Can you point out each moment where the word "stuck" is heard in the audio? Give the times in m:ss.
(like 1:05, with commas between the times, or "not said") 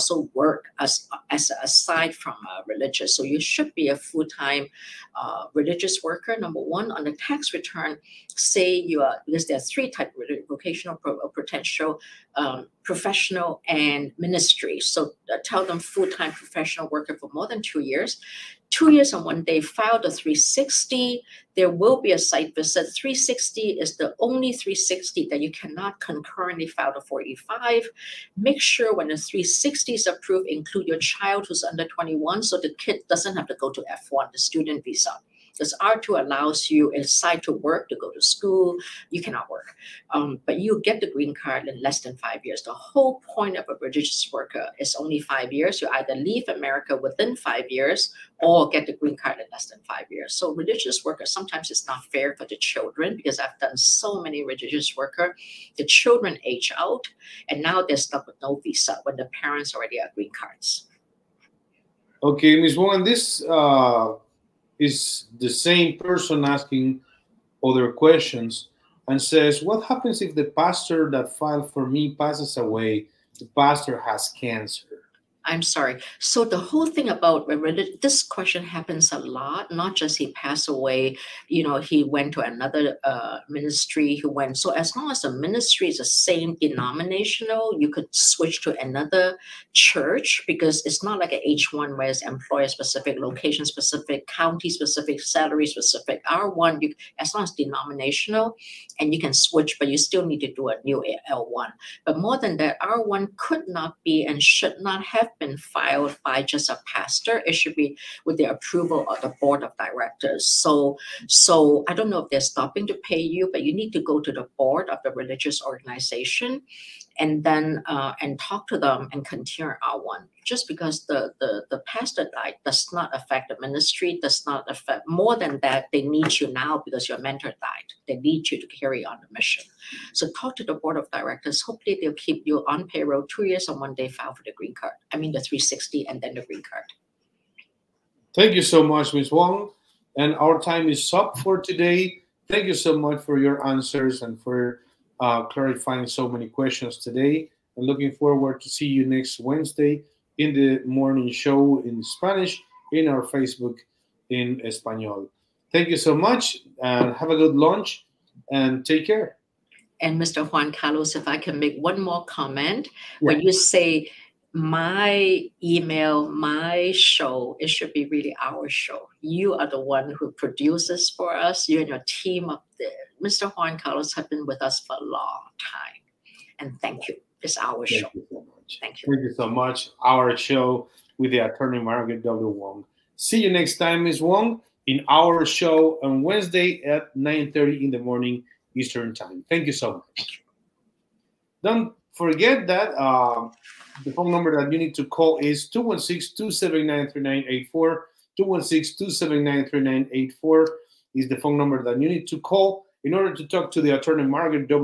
0:57.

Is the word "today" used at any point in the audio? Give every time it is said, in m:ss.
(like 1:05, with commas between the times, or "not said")
2:21, 2:26.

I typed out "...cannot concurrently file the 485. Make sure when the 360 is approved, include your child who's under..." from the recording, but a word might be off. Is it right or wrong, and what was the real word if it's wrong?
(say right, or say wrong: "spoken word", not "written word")
right.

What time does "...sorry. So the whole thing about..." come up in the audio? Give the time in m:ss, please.
1:15.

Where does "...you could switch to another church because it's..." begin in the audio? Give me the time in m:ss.
1:27.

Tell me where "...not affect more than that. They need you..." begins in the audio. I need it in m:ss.
2:04.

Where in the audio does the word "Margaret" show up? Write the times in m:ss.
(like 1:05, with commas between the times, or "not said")
3:01, 3:24.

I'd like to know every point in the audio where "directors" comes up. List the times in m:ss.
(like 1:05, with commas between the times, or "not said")
1:49, 2:11.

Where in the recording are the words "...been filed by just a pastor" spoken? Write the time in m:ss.
1:45.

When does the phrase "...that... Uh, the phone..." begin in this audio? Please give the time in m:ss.
3:12.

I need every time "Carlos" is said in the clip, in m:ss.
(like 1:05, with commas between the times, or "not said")
2:40, 2:53.